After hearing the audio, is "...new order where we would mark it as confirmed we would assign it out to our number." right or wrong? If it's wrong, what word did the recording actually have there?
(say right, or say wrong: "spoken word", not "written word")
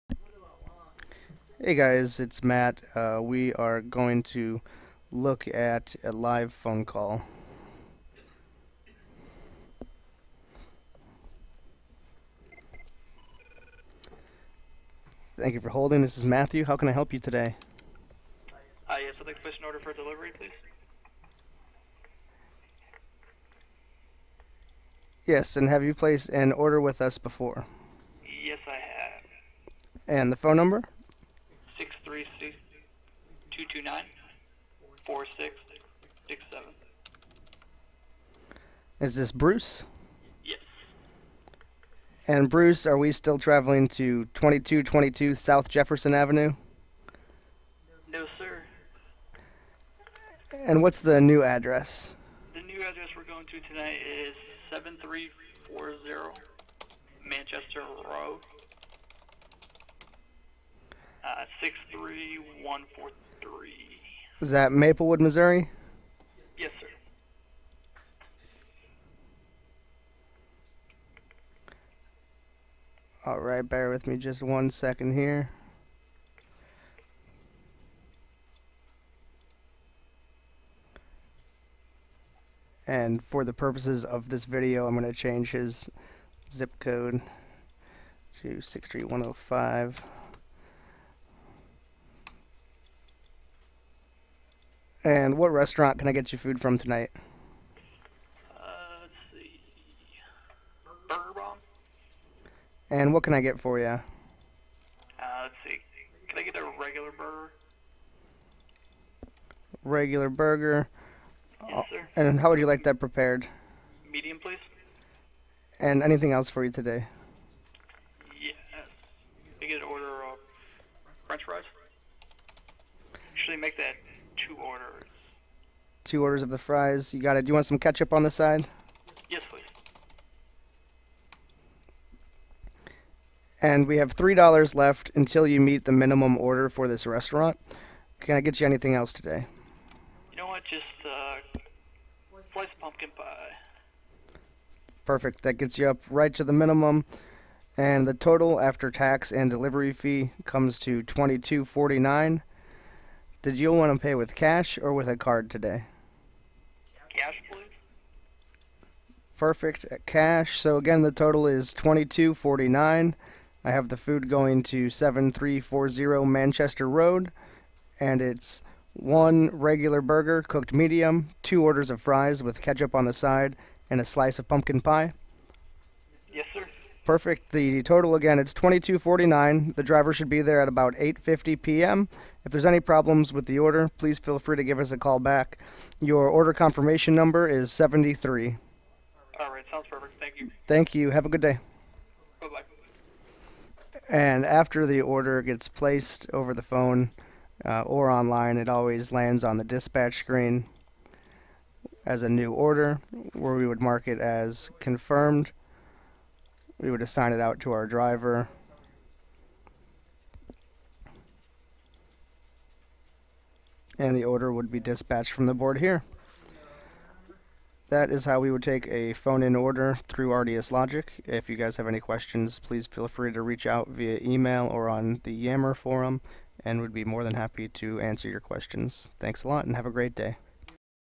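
wrong: "driver", not "number".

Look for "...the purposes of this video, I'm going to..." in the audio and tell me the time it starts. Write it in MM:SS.
01:23.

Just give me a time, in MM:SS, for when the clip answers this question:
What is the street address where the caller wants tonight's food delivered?
00:54.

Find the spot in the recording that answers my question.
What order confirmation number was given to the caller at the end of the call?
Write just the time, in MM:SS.
03:07.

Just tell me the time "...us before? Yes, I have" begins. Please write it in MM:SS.
00:27.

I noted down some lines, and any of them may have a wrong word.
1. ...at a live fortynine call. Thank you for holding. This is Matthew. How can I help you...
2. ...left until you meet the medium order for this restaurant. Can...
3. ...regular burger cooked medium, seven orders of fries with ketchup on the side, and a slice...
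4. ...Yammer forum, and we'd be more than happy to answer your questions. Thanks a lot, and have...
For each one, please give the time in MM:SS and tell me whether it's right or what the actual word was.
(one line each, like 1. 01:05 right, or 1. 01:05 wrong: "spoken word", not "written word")
1. 00:05 wrong: "phone", not "fortynine"
2. 02:14 wrong: "minimum", not "medium"
3. 02:49 wrong: "two", not "seven"
4. 03:45 right.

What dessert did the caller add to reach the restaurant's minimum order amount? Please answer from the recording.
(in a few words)
Sliced pumpkin pie.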